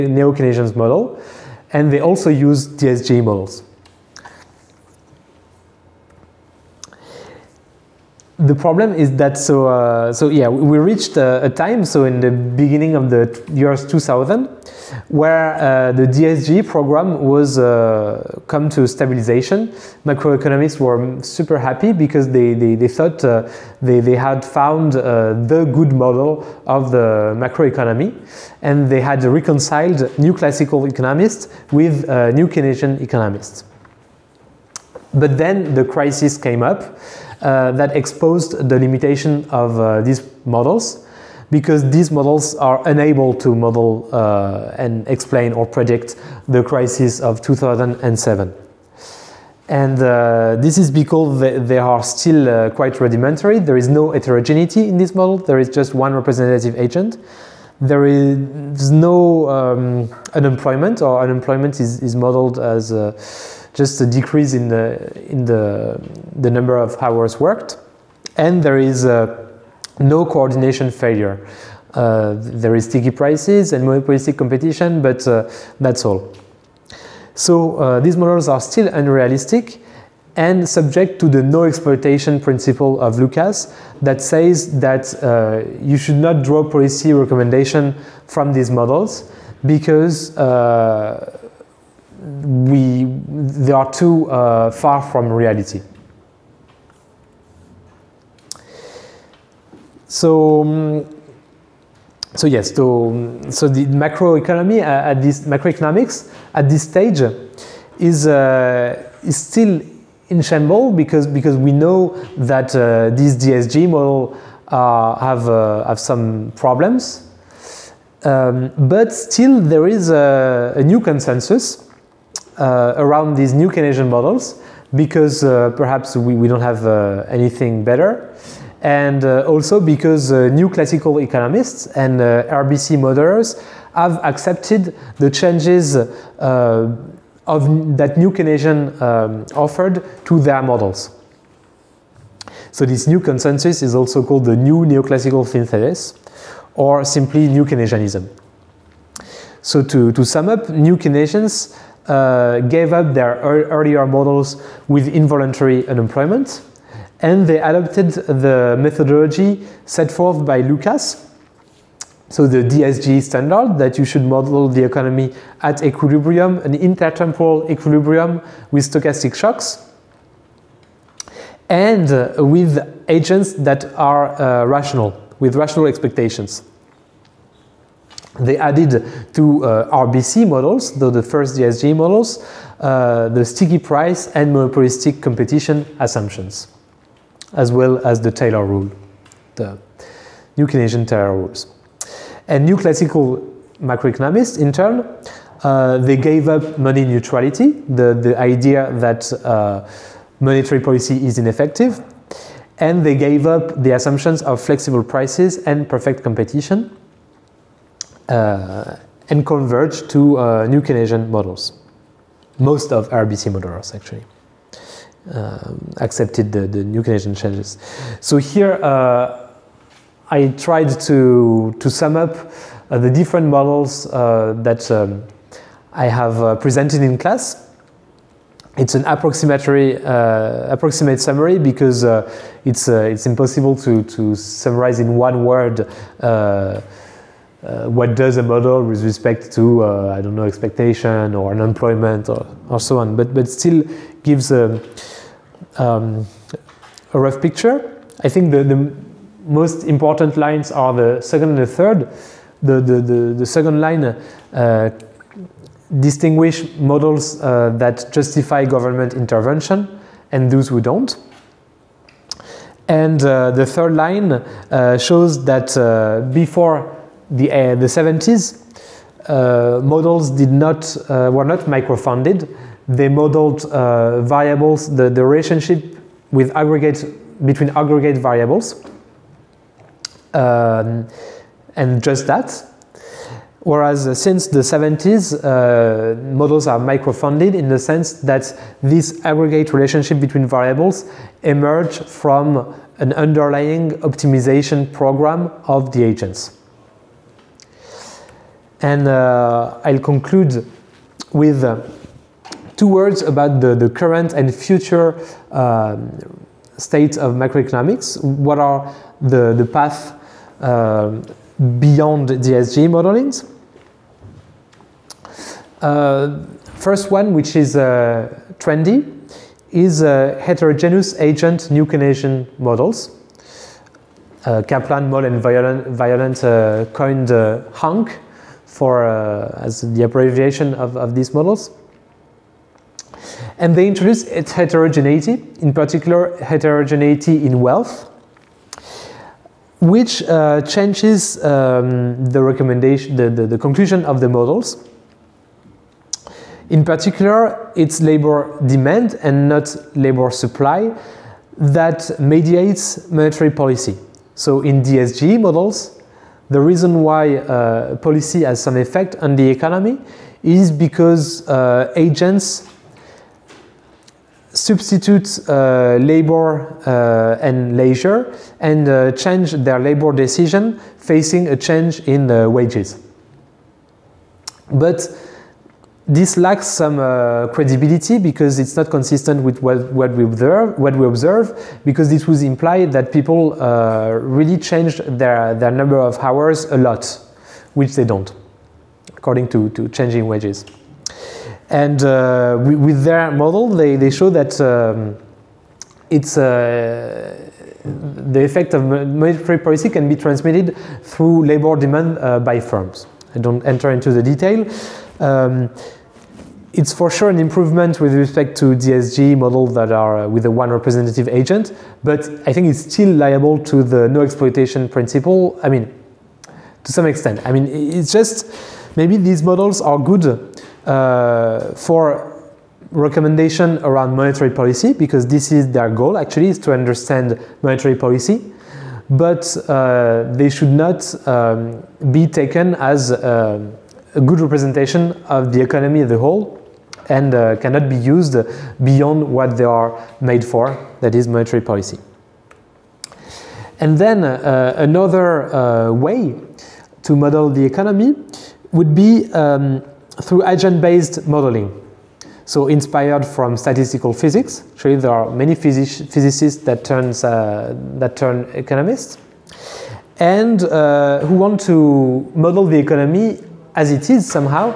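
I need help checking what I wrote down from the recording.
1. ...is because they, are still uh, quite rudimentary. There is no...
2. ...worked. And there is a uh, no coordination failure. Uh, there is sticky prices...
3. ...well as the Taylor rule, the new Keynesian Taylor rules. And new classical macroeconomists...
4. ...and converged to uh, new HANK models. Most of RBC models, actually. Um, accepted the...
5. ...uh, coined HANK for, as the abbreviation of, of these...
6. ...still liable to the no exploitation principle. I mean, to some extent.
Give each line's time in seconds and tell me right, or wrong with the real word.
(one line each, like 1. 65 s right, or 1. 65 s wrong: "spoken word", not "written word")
1. 50 s right
2. 67 s right
3. 187 s right
4. 209 s wrong: "Keynesian", not "HANK"
5. 326 s right
6. 412 s right.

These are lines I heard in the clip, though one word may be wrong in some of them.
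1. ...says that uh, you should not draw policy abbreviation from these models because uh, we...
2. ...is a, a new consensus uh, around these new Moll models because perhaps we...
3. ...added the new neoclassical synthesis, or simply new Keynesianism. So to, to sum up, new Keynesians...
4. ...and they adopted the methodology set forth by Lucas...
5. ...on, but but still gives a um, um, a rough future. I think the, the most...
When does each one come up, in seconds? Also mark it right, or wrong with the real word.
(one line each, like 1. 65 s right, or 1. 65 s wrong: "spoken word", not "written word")
1. 84 s wrong: "recommendation", not "abbreviation"
2. 119 s wrong: "Keynesian", not "Moll"
3. 144 s wrong: "called", not "added"
4. 157 s right
5. 242 s wrong: "picture", not "future".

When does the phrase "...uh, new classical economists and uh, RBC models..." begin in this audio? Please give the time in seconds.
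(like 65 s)
130 s.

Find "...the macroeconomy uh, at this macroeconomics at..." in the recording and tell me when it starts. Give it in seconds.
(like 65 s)
103 s.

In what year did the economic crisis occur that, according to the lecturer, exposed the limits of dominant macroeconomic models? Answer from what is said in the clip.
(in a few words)
2007.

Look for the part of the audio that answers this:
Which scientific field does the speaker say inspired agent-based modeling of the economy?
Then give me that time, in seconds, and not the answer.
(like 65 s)
453 s.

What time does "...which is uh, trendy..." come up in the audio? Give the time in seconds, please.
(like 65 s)
317 s.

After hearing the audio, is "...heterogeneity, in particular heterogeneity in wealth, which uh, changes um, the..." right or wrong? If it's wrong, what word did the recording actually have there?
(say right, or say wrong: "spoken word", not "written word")
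right.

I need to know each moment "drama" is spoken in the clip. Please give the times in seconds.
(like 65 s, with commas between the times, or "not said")
not said.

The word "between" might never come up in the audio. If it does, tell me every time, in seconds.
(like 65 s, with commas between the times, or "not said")
277 s, 290 s.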